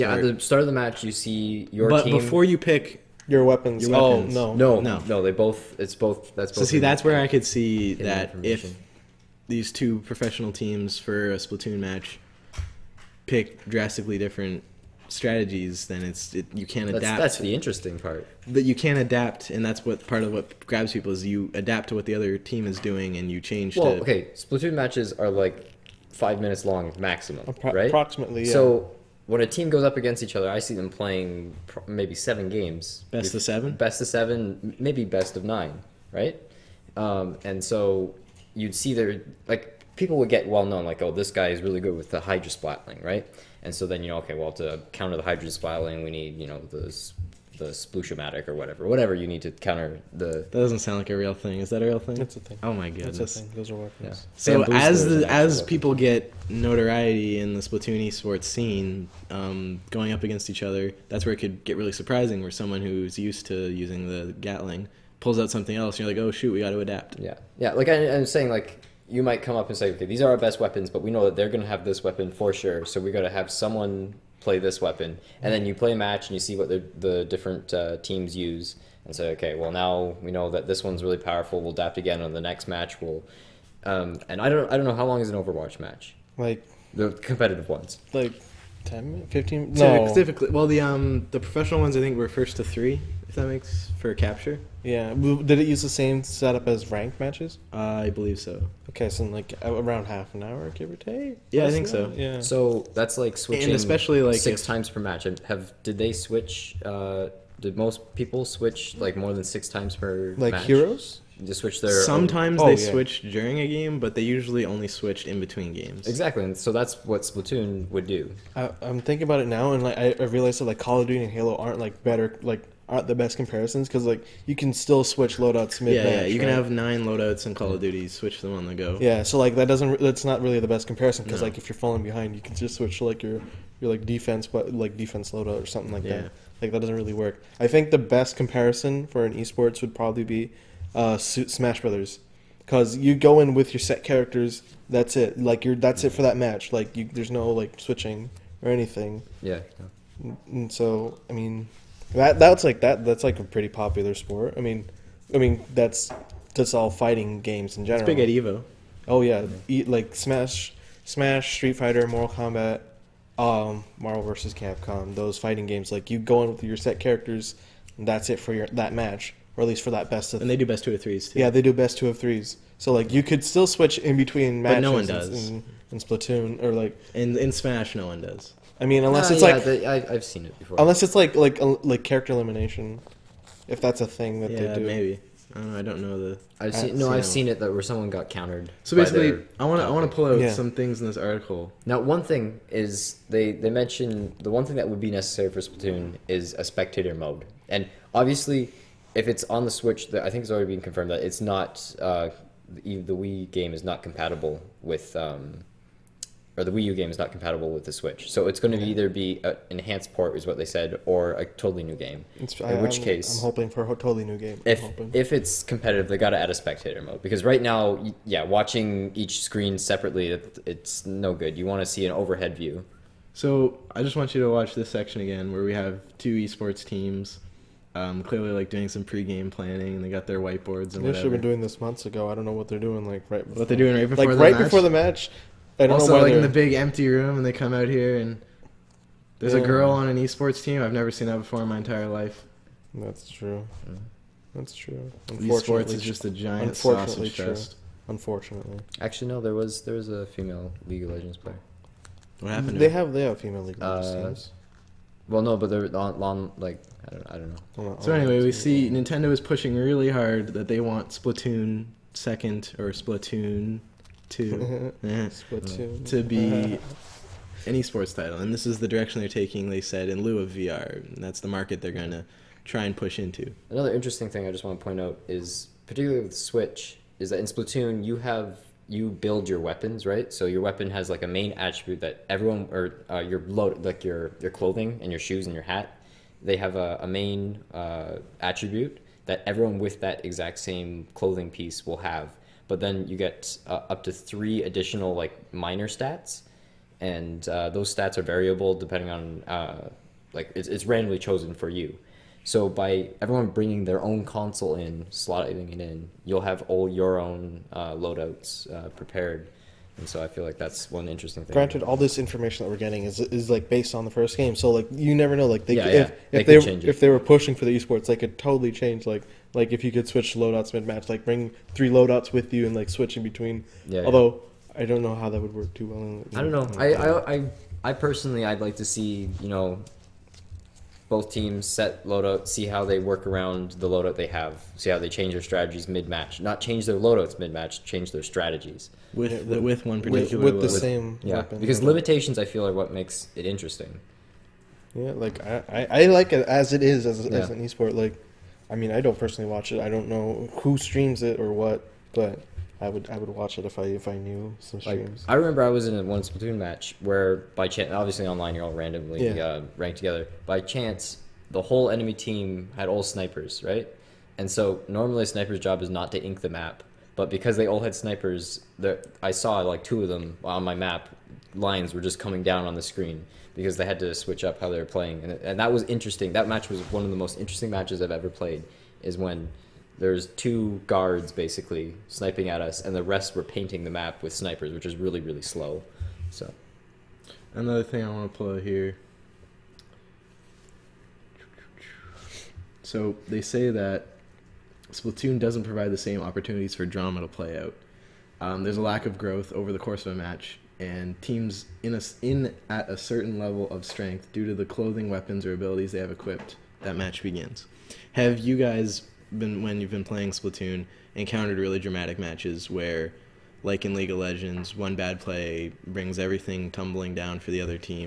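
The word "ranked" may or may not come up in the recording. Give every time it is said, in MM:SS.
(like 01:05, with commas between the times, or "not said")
01:36, 05:59.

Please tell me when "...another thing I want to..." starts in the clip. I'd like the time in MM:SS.
06:27.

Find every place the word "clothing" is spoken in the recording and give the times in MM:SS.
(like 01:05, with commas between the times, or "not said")
04:44, 04:51, 06:44.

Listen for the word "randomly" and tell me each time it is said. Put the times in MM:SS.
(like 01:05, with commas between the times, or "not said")
05:00, 05:58.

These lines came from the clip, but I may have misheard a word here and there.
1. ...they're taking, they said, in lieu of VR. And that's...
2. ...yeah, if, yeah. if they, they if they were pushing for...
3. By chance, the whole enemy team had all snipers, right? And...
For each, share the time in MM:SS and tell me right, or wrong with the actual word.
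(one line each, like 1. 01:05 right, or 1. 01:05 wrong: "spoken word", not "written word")
1. 04:29 right
2. 05:15 right
3. 06:00 right.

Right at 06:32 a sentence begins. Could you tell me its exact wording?
So they say that Splatoon doesn't provide the same opportunities for drama to play out.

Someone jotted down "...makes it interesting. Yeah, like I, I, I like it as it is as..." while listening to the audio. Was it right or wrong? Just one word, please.
right.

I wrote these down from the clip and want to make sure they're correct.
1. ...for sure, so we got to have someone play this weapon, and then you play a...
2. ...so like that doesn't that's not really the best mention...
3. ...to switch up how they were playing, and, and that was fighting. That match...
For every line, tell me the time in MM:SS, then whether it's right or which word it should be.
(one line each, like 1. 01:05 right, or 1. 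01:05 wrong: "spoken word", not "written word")
1. 01:12 right
2. 02:09 wrong: "comparison", not "mention"
3. 06:13 wrong: "interesting", not "fighting".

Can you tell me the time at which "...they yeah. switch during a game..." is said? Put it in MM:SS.
01:52.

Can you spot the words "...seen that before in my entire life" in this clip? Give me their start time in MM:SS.
04:01.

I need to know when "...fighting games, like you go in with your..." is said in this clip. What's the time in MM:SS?
02:45.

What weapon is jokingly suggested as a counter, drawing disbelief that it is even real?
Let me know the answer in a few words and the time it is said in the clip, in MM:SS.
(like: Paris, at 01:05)
Sploosh-o-matic, at 00:47.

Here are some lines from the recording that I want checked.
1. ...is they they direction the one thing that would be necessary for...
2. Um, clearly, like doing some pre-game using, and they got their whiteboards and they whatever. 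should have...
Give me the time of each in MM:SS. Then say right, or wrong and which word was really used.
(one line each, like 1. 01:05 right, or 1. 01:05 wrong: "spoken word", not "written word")
1. 03:12 wrong: "mention", not "direction"
2. 03:47 wrong: "planning", not "using".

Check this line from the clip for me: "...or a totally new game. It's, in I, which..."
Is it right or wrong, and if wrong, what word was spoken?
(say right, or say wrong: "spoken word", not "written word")
right.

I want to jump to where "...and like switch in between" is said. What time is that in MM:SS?
05:22.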